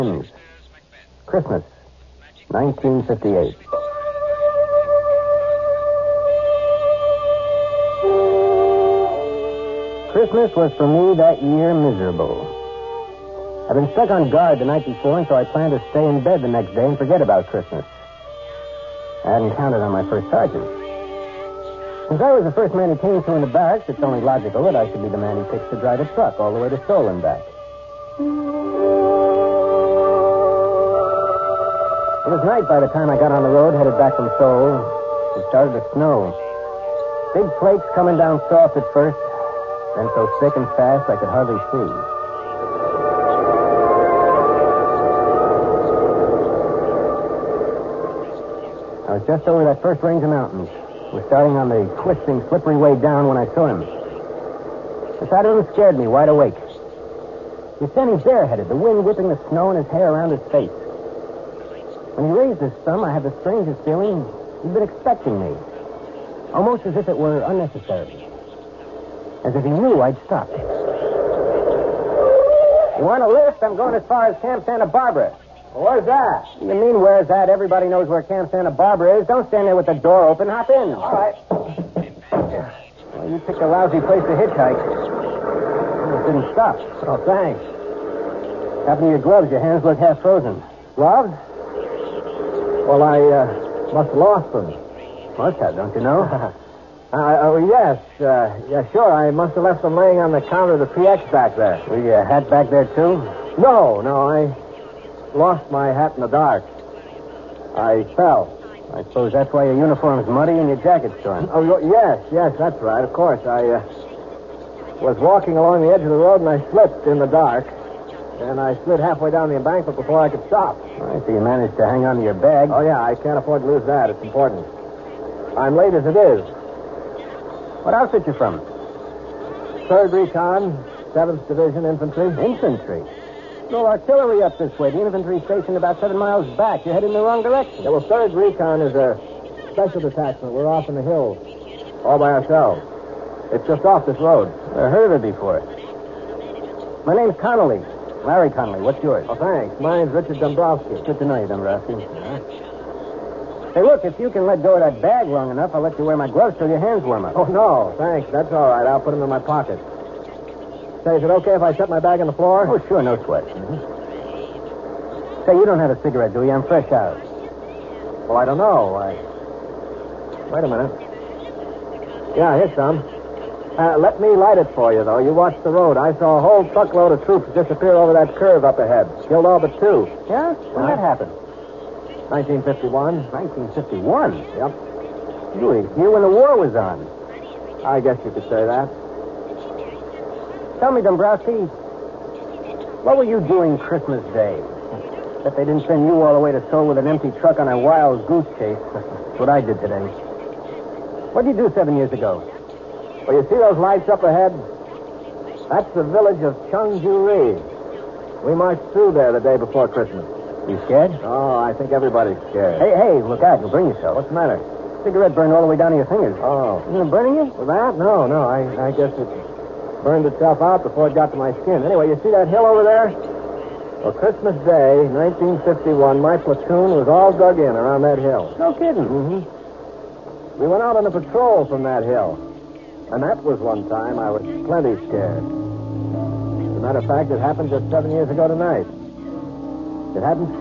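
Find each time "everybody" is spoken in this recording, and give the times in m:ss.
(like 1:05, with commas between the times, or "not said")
1:17, 3:31.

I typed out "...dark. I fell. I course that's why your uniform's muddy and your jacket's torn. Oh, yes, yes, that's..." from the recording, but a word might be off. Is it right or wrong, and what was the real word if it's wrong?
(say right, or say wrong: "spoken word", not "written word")
wrong: "suppose", not "course".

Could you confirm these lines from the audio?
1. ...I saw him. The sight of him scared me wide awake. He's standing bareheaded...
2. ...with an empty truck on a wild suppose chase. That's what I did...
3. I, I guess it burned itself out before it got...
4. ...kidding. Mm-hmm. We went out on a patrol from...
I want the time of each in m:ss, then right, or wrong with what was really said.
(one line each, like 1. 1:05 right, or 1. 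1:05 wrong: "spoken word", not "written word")
1. 0:53 right
2. 3:16 wrong: "goose", not "suppose"
3. 3:38 right
4. 3:48 right.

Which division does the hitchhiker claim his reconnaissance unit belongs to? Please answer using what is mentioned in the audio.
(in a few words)
Seventh Division Infantry.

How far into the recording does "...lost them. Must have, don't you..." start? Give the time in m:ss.
1:34.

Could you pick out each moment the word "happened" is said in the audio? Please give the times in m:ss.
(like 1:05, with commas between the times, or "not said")
1:28, 3:01, 3:57.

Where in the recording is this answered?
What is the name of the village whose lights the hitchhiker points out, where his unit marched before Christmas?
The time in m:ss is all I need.
3:26.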